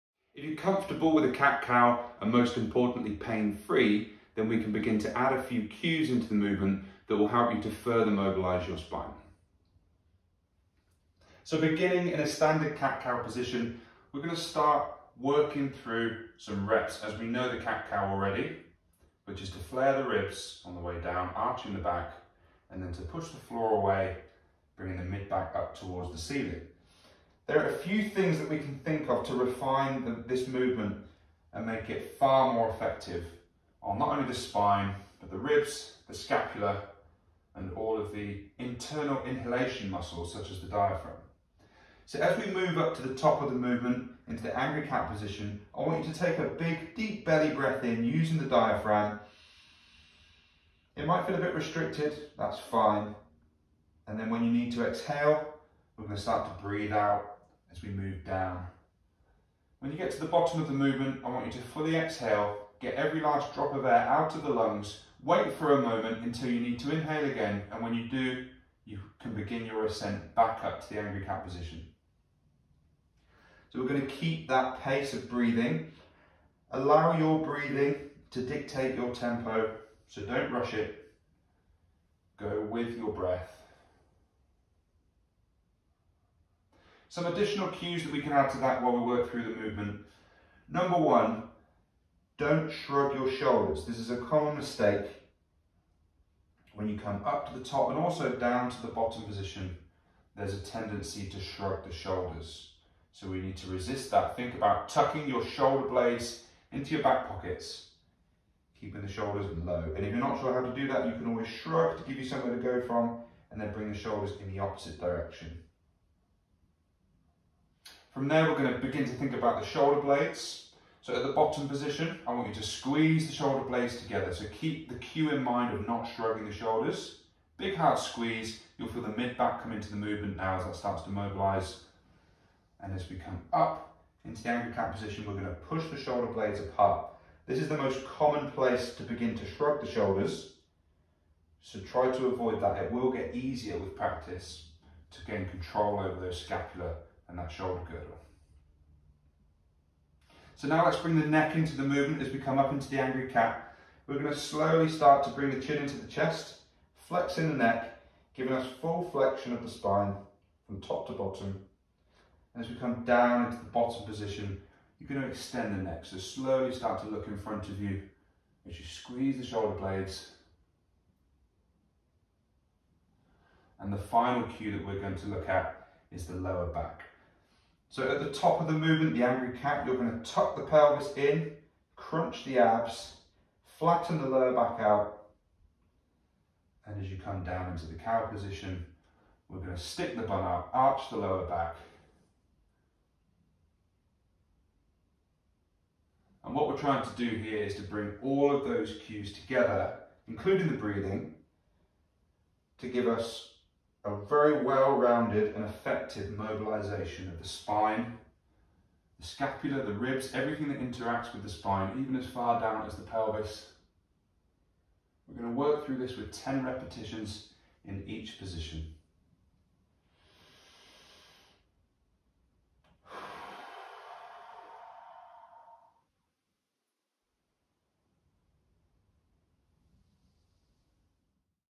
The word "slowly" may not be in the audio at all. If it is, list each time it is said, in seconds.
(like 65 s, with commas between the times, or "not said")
154 s, 166 s.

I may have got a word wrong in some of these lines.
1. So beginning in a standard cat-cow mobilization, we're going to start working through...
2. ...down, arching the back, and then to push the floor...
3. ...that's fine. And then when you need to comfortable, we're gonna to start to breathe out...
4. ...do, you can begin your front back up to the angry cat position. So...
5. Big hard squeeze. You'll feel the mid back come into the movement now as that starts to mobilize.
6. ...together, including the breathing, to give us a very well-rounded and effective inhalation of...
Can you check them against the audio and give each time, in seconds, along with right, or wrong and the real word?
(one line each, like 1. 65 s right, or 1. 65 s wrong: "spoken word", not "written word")
1. 11 s wrong: "position", not "mobilization"
2. 21 s right
3. 52 s wrong: "exhale", not "comfortable"
4. 68 s wrong: "ascent", not "front"
5. 127 s right
6. 199 s wrong: "mobilization", not "inhalation".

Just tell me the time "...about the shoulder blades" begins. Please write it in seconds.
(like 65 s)
119 s.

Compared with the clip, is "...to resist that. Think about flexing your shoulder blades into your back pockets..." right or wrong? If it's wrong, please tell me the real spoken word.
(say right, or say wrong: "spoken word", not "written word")
wrong: "tucking", not "flexing".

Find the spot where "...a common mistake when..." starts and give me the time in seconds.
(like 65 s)
94 s.